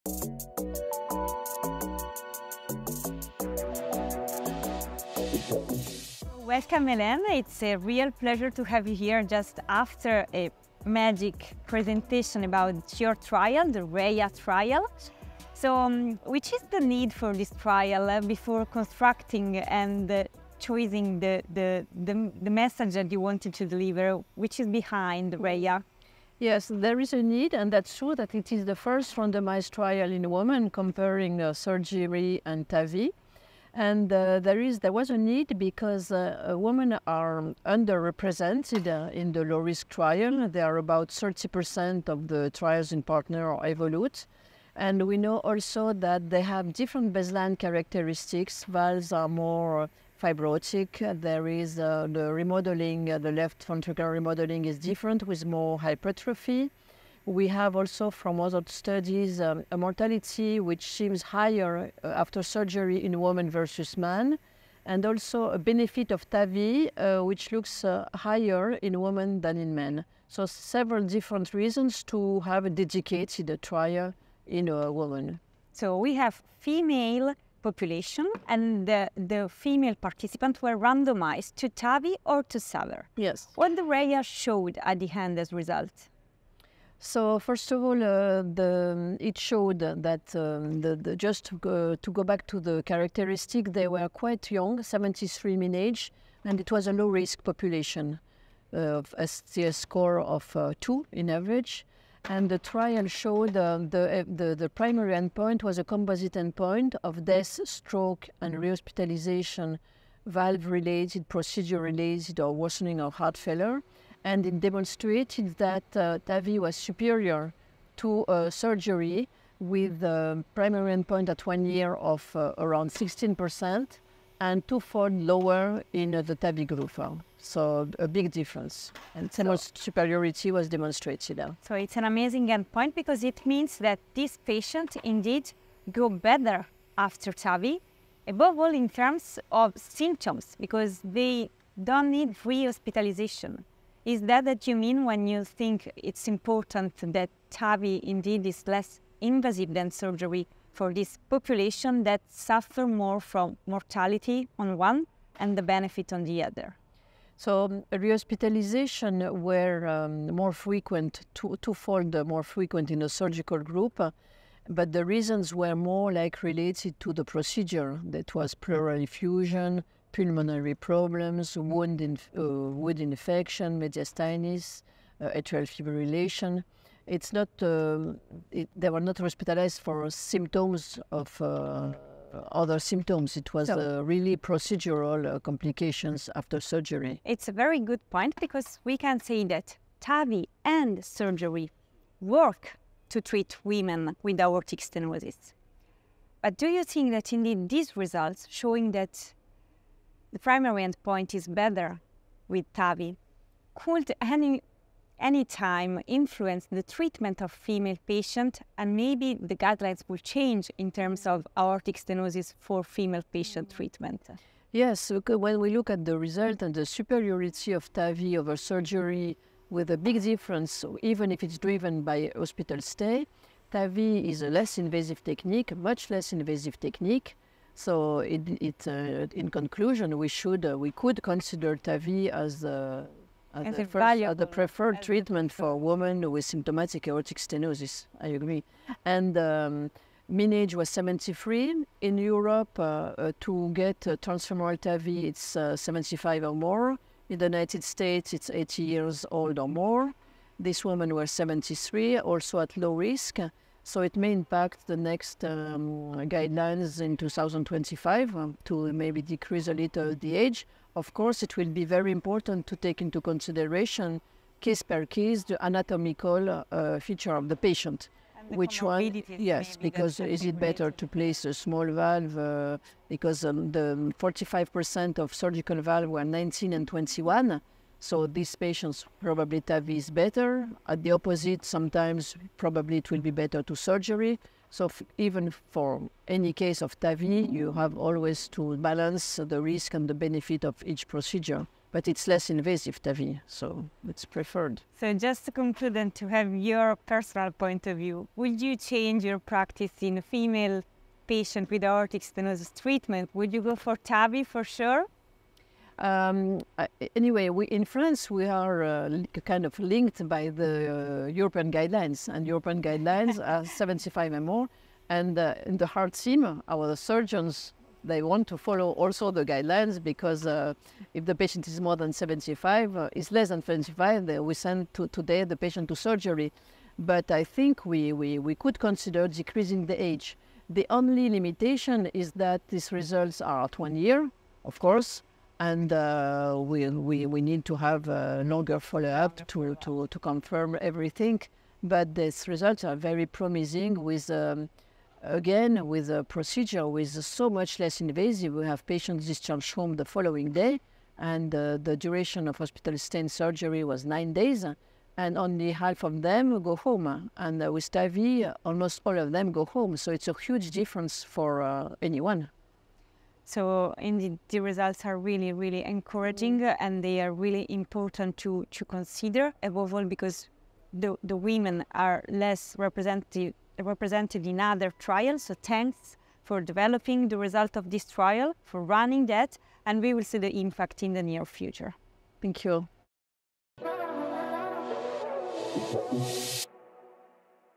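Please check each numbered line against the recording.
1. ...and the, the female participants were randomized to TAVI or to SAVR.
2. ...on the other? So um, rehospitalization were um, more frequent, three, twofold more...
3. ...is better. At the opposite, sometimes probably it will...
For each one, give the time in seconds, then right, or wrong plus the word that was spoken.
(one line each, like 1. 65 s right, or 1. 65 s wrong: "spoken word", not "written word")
1. 78 s right
2. 156 s wrong: "two", not "three"
3. 279 s right.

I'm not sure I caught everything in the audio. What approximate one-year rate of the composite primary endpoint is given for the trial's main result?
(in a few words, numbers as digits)
16%.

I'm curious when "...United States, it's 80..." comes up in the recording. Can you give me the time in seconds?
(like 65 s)
247 s.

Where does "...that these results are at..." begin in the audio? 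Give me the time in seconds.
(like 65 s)
332 s.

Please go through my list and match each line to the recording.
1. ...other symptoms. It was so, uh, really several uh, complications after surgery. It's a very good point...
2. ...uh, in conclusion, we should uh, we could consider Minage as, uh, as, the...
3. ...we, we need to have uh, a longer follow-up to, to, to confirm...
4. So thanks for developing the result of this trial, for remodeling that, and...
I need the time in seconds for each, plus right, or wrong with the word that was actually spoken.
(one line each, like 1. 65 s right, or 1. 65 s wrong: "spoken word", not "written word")
1. 182 s wrong: "procedural", not "several"
2. 228 s wrong: "TAVI", not "Minage"
3. 336 s right
4. 375 s wrong: "running", not "remodeling".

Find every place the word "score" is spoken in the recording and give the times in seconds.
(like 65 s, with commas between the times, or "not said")
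99 s.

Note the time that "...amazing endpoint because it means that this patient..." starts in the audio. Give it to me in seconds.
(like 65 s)
132 s.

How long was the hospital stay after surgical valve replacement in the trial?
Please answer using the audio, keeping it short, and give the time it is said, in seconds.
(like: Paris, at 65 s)
9 days, at 354 s.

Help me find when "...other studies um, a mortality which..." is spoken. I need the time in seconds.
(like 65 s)
58 s.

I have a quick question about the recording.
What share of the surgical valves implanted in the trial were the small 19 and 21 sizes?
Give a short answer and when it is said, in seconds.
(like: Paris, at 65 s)
45%, at 274 s.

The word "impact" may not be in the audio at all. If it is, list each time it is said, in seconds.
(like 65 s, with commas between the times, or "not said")
254 s, 380 s.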